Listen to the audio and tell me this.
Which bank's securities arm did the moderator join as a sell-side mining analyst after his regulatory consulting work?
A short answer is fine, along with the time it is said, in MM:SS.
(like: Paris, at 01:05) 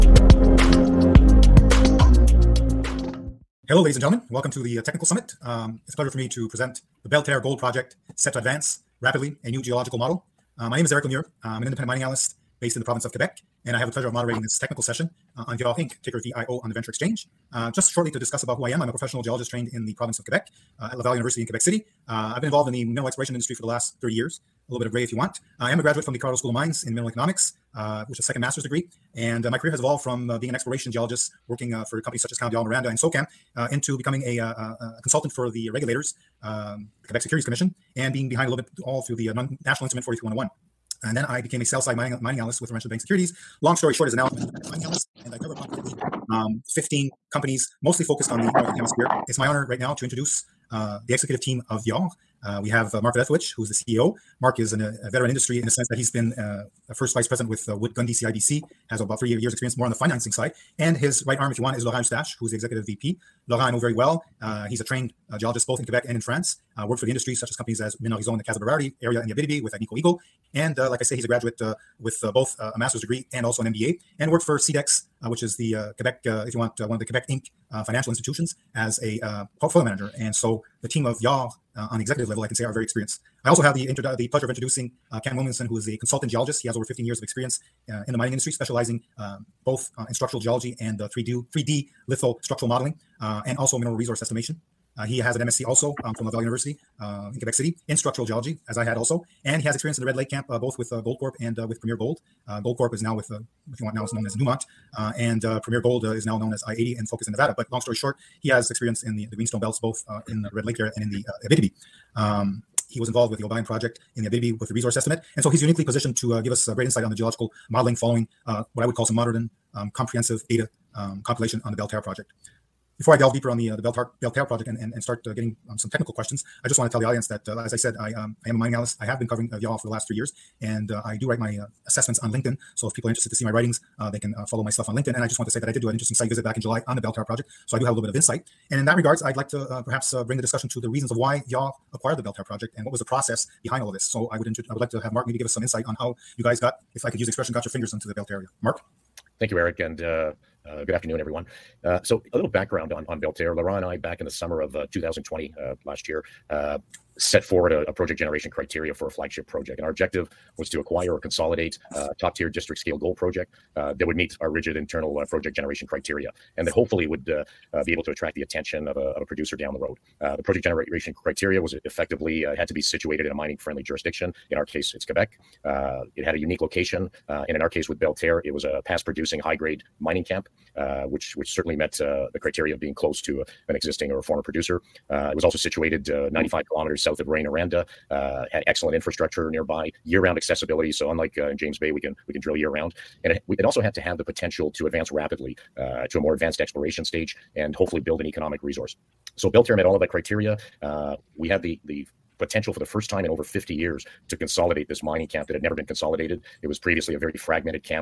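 Laurentian Bank, at 00:42.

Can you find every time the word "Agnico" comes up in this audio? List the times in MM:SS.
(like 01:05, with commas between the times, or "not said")
01:09.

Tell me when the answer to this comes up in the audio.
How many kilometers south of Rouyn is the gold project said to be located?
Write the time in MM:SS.
03:06.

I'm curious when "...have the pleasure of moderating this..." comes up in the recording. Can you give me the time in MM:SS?
00:13.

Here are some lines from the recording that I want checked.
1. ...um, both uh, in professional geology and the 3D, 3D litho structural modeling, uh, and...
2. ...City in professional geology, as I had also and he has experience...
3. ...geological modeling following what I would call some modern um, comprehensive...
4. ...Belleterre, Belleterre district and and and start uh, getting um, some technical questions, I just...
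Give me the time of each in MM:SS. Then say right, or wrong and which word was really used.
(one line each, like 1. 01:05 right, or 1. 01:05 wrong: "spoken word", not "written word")
1. 01:29 wrong: "structural", not "professional"
2. 01:37 wrong: "structural", not "professional"
3. 01:57 right
4. 02:03 wrong: "project", not "district".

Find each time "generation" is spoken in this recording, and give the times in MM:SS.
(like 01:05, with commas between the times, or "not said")
02:38, 02:45, 02:50.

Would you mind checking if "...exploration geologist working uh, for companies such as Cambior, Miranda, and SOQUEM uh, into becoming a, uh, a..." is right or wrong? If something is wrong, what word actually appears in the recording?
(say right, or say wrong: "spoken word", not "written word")
right.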